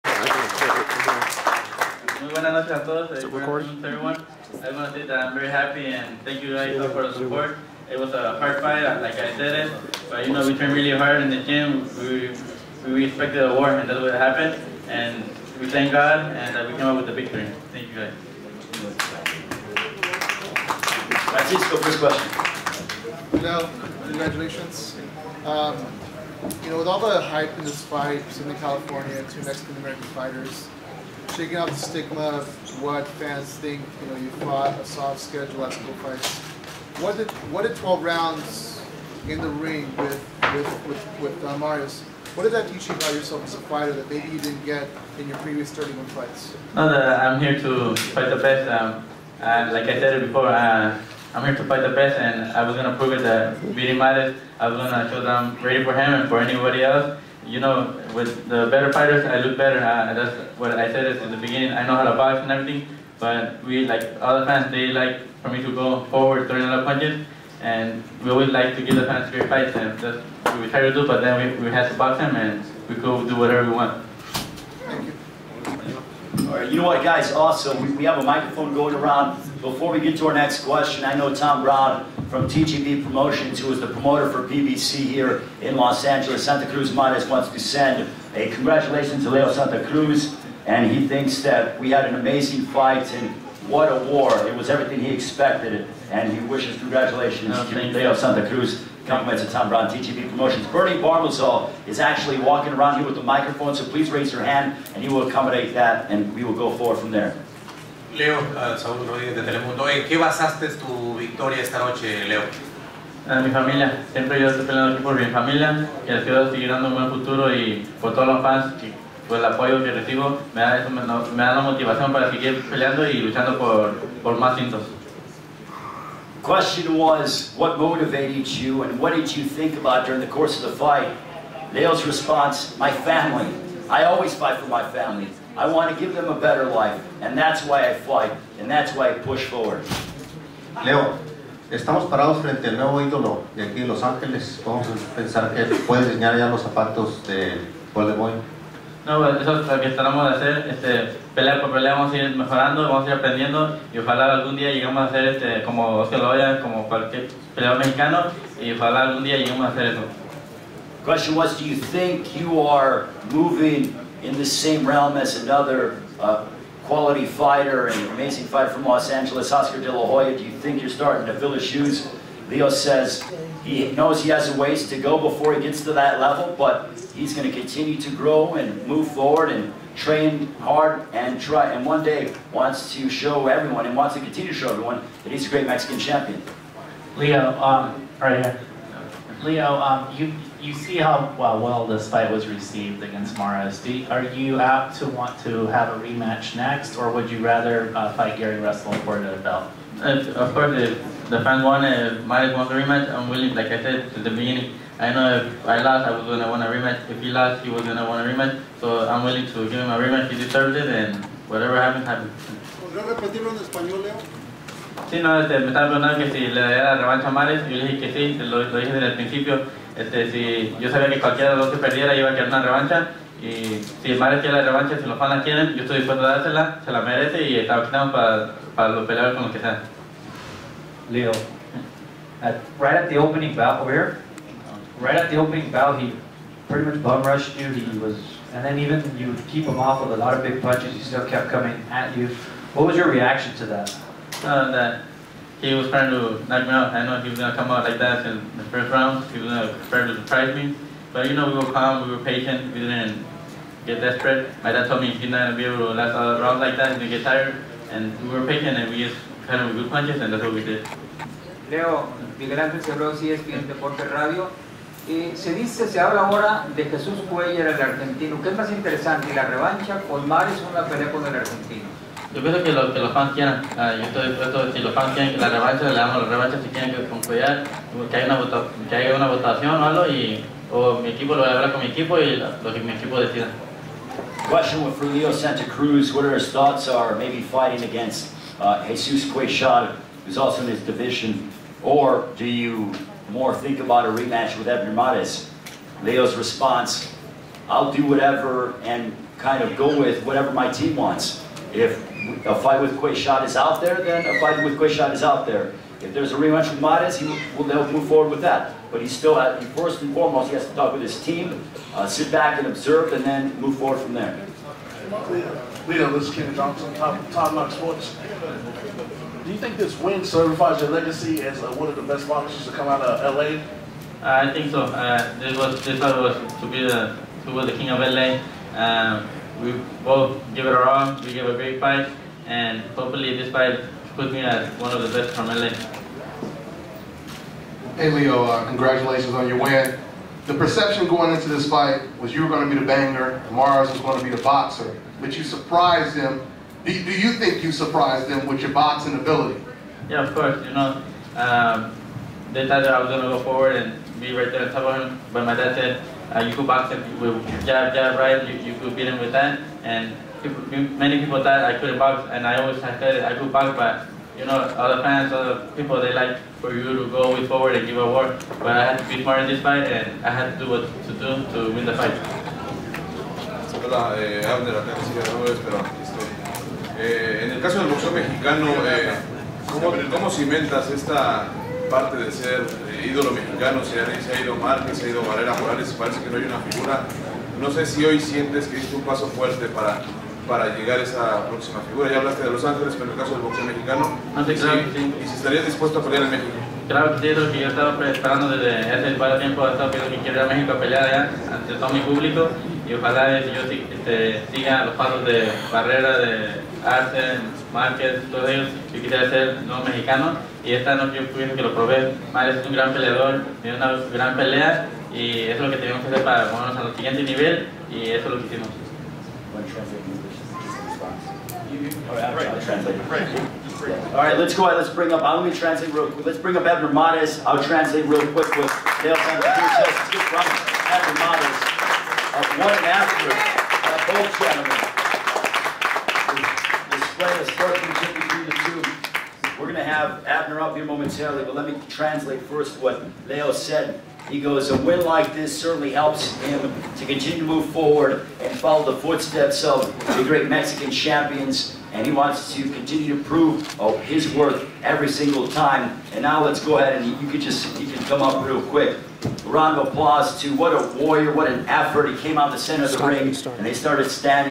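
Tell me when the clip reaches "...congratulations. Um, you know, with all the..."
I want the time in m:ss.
0:24.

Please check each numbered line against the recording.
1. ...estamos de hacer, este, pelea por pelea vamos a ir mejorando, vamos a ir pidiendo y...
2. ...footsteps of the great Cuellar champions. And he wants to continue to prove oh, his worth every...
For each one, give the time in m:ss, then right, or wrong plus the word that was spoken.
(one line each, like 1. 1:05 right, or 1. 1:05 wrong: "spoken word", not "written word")
1. 2:29 wrong: "aprendiendo", not "pidiendo"
2. 7:29 wrong: "Mexican", not "Cuellar".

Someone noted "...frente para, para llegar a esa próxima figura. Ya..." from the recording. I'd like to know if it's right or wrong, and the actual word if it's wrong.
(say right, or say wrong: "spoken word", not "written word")
wrong: "fuerte", not "frente".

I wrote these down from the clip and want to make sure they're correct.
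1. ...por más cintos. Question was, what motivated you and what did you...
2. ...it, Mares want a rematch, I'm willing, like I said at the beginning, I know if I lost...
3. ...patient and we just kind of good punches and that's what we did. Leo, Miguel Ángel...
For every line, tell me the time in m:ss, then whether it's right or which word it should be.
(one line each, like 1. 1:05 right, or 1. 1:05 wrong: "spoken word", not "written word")
1. 2:04 right
2. 3:21 right
3. 4:18 right.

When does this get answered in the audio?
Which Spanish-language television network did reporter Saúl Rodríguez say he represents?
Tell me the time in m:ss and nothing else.
1:49.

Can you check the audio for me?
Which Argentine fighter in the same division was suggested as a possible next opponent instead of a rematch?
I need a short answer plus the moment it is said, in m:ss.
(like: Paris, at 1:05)
Jesús Cuellar, at 4:26.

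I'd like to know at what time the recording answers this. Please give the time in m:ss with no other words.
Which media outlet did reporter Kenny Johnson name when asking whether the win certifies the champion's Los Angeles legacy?
5:17.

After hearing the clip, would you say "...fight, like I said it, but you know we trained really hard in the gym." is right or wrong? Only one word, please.
right.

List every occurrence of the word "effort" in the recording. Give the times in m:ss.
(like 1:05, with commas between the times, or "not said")
7:41.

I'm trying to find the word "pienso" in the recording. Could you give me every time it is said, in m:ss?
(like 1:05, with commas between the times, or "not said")
4:32, 6:51.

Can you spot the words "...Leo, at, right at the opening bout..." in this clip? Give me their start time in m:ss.
3:51.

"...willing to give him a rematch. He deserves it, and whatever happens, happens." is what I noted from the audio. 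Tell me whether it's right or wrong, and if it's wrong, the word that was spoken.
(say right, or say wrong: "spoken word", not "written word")
right.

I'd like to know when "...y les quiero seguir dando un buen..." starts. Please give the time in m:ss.
1:56.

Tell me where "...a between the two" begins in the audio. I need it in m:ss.
7:17.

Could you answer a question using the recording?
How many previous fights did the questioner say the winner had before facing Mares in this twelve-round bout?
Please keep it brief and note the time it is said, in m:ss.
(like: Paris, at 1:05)
31, at 0:45.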